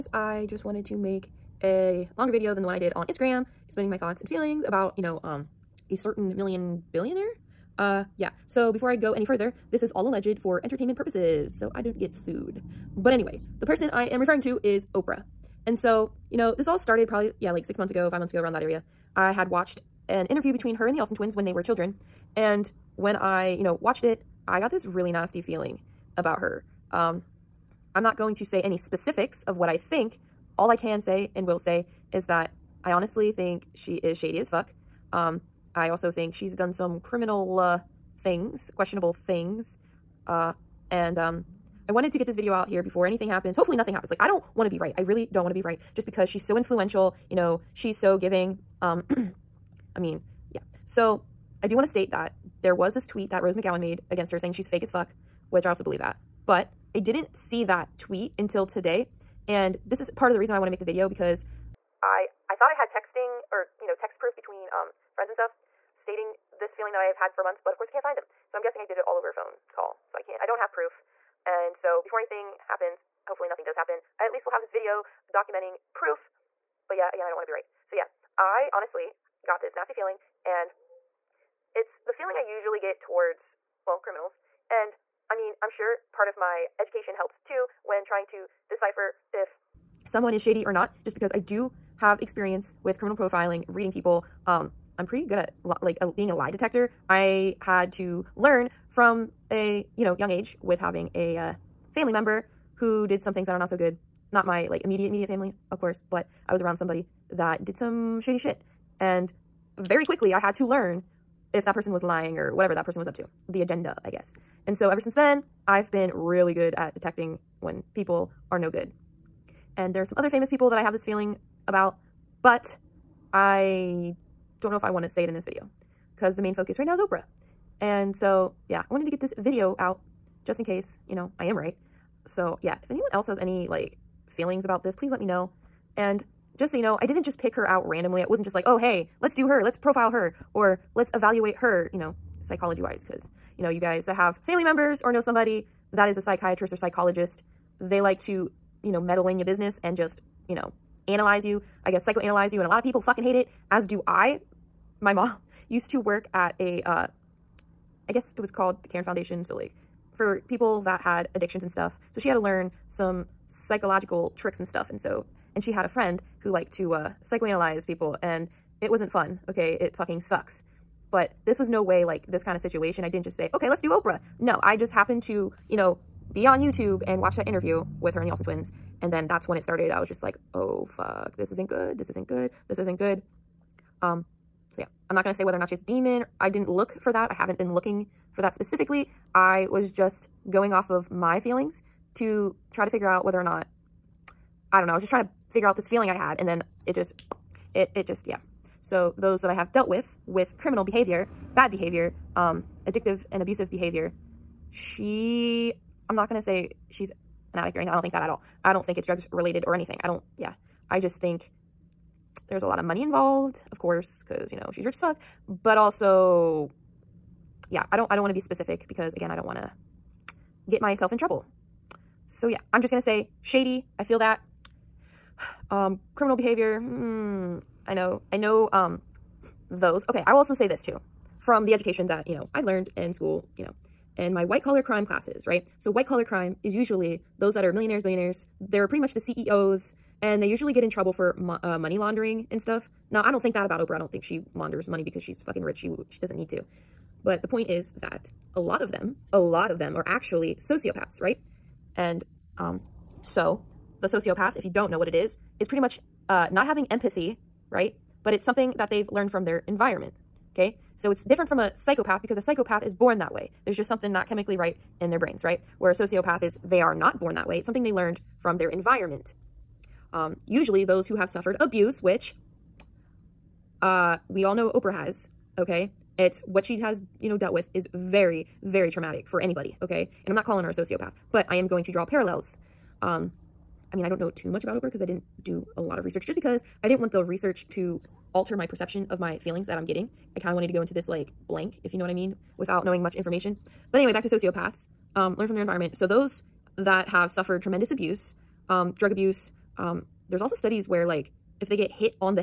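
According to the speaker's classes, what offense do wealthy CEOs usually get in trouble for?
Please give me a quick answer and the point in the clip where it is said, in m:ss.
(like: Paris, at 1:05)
money laundering, at 4:01.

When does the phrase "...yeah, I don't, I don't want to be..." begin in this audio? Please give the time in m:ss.
3:37.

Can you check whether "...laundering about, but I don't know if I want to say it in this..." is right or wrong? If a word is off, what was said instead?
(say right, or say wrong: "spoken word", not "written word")
wrong: "feeling", not "laundering".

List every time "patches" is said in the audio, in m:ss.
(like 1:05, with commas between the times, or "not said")
not said.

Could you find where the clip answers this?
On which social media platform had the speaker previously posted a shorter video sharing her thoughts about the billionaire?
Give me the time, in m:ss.
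0:03.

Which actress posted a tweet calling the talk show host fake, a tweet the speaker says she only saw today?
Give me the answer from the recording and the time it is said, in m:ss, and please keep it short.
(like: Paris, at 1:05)
Rose McGowan, at 0:53.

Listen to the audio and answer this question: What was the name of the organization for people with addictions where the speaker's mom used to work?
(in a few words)
Karen Foundation.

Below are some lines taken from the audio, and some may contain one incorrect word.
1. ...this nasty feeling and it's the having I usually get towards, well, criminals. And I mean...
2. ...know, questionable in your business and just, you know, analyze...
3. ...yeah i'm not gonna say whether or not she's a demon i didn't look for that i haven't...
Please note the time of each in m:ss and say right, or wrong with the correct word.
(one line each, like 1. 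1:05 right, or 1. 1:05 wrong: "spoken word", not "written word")
1. 1:19 wrong: "feeling", not "having"
2. 2:28 wrong: "meddle", not "questionable"
3. 3:04 right.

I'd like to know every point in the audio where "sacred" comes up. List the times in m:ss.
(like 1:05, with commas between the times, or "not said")
not said.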